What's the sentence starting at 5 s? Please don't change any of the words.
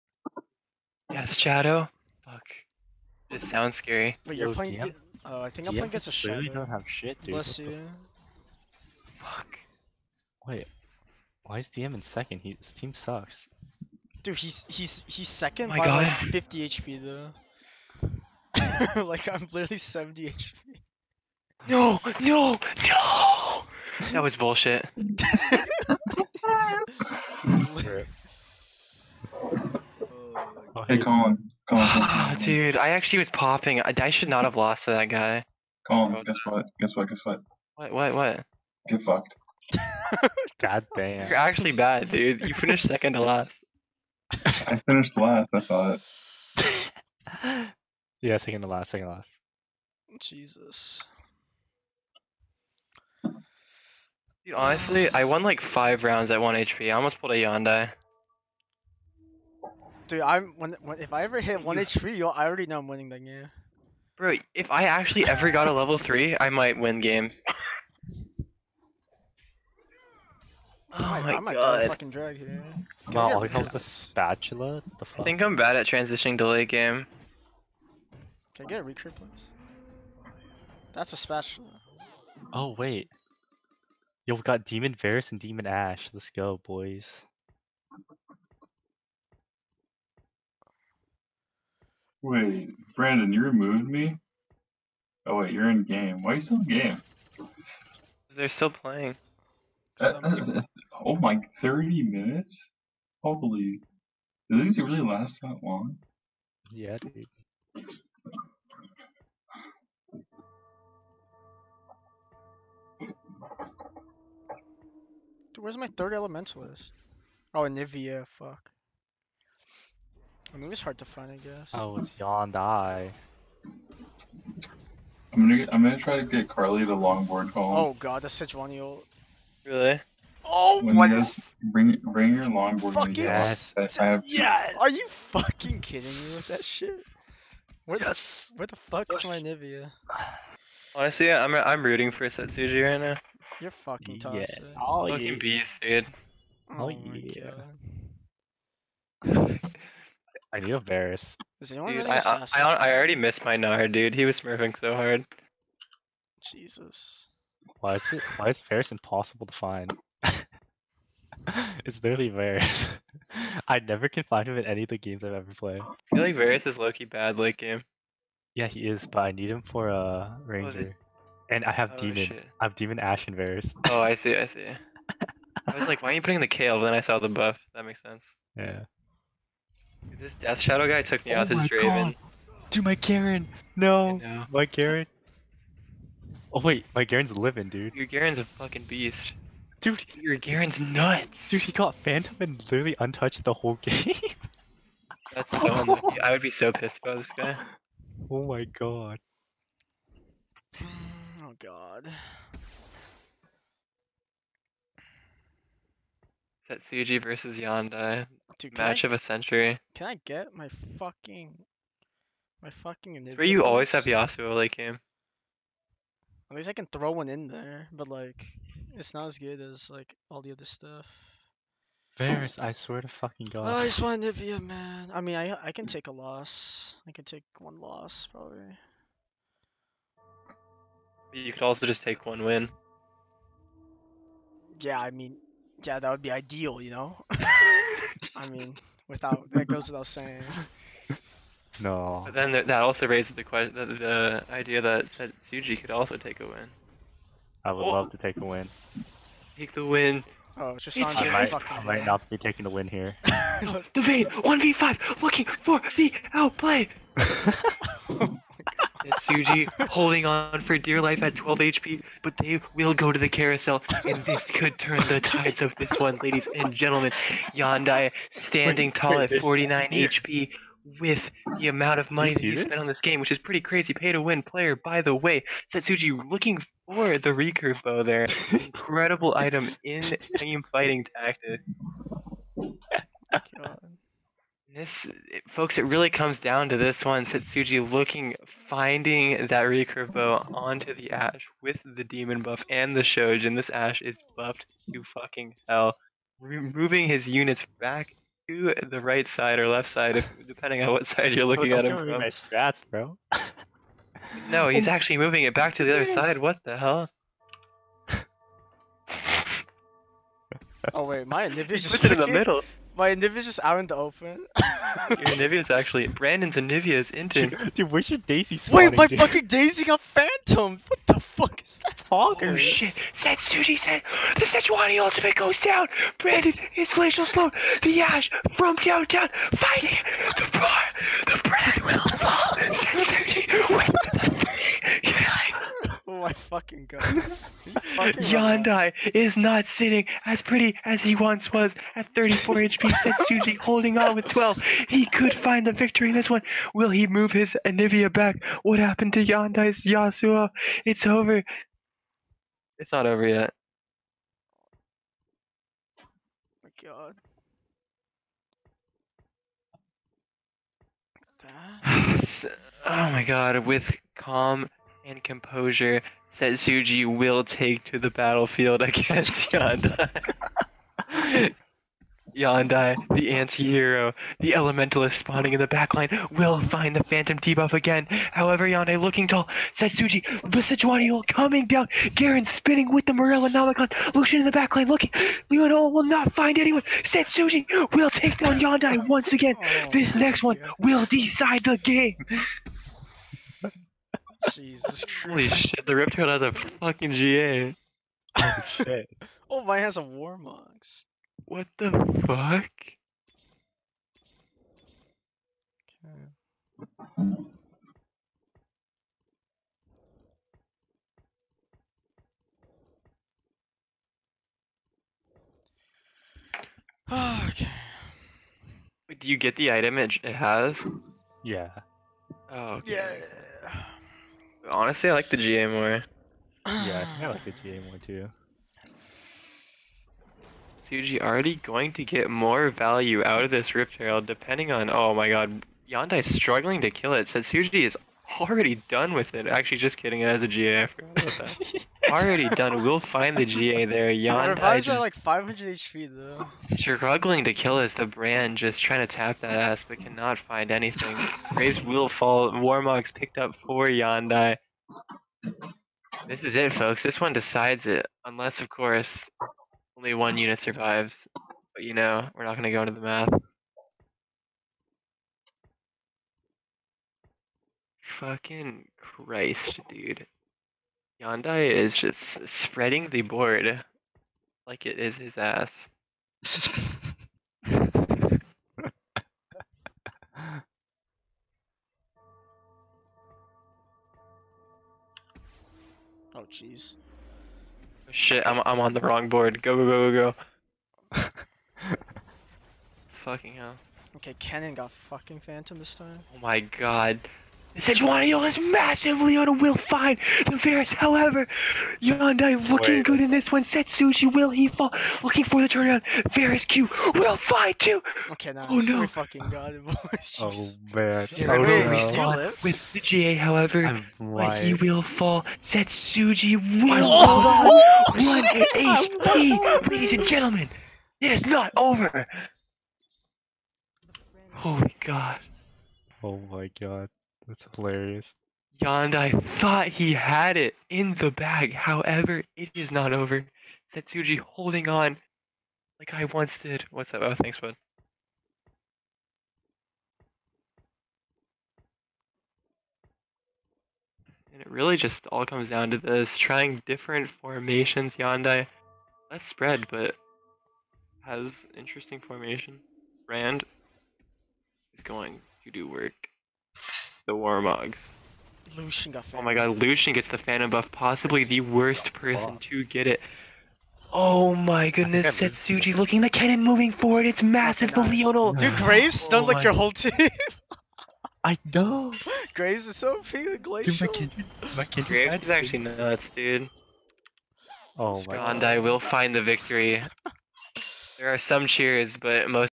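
Oh, I think I'm playing against a shadow.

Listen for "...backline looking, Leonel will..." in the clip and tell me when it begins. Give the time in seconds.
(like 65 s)
384 s.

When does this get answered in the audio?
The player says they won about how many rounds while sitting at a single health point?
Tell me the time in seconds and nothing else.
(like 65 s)
55 s.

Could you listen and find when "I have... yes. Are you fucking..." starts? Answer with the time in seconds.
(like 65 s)
133 s.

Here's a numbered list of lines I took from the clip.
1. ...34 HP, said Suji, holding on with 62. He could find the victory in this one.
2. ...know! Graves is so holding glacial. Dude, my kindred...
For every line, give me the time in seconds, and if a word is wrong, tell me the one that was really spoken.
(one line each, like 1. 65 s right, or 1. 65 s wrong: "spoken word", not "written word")
1. 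342 s wrong: "12", not "62"
2. 571 s wrong: "feeling", not "holding".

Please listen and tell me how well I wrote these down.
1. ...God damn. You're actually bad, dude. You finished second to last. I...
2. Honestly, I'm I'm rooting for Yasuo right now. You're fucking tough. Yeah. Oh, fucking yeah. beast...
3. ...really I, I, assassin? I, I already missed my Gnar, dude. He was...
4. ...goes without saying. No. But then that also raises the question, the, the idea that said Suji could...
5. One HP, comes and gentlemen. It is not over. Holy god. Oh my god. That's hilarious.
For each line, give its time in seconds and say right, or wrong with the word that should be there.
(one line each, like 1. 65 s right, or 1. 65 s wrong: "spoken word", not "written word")
1. 40 s right
2. 140 s wrong: "Satsuji", not "Yasuo"
3. 151 s right
4. 239 s right
5. 518 s wrong: "ladies", not "comes".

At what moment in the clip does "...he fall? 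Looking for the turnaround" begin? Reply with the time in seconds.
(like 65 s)
504 s.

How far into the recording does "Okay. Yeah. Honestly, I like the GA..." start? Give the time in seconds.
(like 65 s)
422 s.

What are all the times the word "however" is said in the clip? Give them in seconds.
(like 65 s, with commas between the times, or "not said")
378 s, 500 s, 513 s, 531 s.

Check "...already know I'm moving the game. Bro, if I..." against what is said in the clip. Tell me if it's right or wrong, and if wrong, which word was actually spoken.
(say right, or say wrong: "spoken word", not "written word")
wrong: "winning", not "moving".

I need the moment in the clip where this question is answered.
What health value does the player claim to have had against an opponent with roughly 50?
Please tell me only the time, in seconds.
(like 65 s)
19 s.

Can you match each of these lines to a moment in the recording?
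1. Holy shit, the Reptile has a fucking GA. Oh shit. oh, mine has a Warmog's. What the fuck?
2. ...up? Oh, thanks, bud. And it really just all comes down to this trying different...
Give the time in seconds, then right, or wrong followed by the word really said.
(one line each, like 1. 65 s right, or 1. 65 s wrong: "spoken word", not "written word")
1. 395 s right
2. 537 s right.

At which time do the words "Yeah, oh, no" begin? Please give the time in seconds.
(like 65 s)
511 s.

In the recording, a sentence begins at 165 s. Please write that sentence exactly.
I feel like Varus is Loki bad late game.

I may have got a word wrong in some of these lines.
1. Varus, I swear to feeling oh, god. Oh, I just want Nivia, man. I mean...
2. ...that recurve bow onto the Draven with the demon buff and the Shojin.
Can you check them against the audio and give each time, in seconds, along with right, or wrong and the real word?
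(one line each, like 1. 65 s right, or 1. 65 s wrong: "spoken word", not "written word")
1. 222 s wrong: "fucking", not "feeling"
2. 289 s wrong: "Ashe", not "Draven".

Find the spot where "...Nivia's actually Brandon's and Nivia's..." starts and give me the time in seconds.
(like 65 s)
315 s.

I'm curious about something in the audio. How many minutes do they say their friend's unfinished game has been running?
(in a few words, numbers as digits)
30 minutes.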